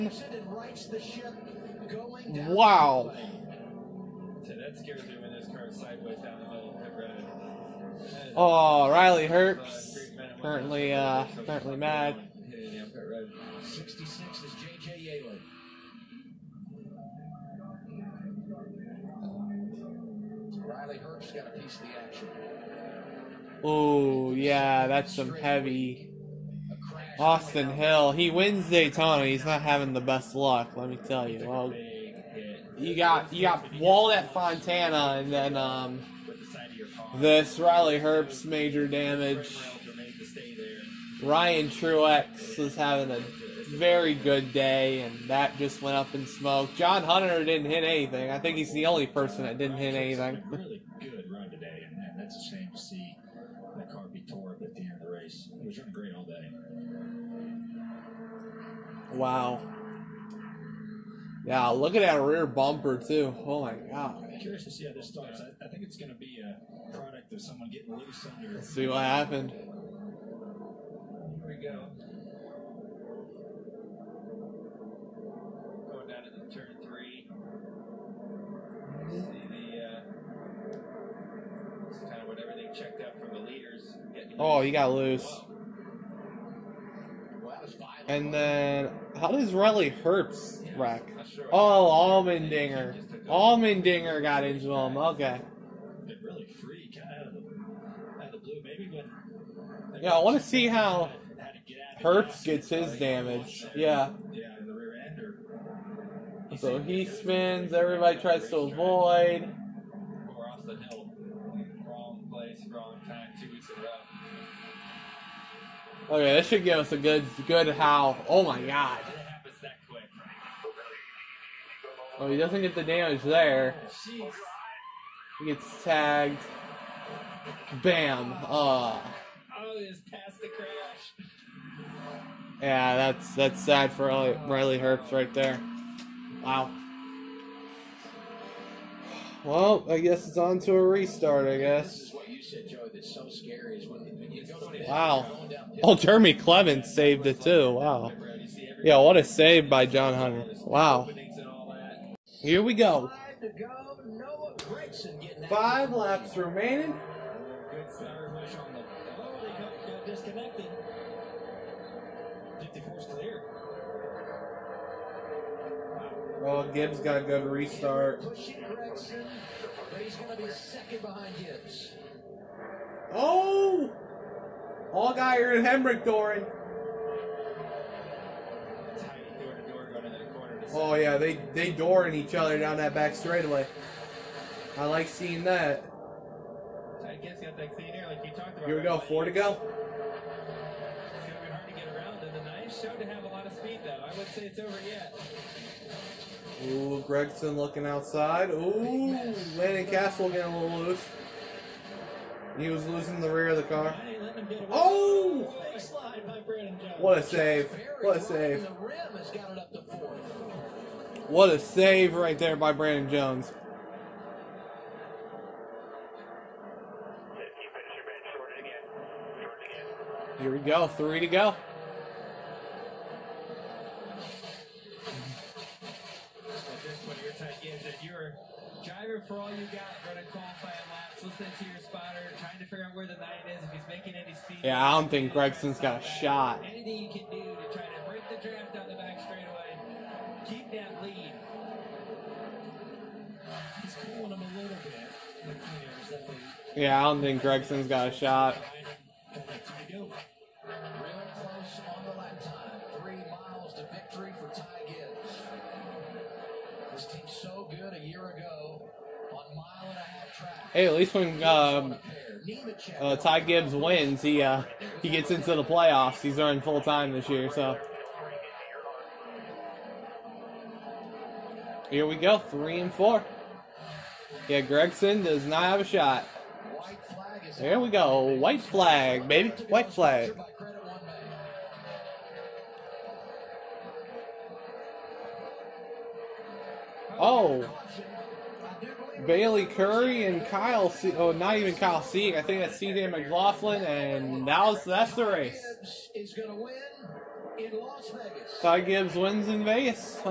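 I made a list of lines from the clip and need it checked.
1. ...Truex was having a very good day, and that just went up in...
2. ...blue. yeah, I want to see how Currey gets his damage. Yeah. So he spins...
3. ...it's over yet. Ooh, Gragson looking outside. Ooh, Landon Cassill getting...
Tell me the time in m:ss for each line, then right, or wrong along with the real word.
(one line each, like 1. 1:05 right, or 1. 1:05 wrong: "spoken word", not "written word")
1. 0:41 right
2. 1:38 wrong: "Herbst", not "Currey"
3. 3:14 right.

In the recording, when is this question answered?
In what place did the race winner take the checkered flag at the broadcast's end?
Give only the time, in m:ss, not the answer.
4:59.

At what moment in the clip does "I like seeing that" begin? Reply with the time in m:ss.
3:04.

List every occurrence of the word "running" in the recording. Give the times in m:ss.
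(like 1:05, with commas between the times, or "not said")
0:55, 3:50.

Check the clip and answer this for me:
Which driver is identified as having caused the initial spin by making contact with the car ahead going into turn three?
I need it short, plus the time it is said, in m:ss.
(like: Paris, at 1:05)
Allmendinger, at 1:33.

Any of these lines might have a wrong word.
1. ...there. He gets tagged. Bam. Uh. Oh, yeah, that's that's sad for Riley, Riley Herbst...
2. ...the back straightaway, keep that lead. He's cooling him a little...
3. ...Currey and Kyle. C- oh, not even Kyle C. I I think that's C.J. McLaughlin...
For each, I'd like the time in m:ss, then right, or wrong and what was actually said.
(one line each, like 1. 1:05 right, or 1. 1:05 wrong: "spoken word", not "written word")
1. 2:03 right
2. 3:58 right
3. 4:49 right.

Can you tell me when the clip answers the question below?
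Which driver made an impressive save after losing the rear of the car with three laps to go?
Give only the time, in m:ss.
3:32.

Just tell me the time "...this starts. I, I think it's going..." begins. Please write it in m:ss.
1:04.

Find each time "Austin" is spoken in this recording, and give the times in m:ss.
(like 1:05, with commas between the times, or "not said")
0:27.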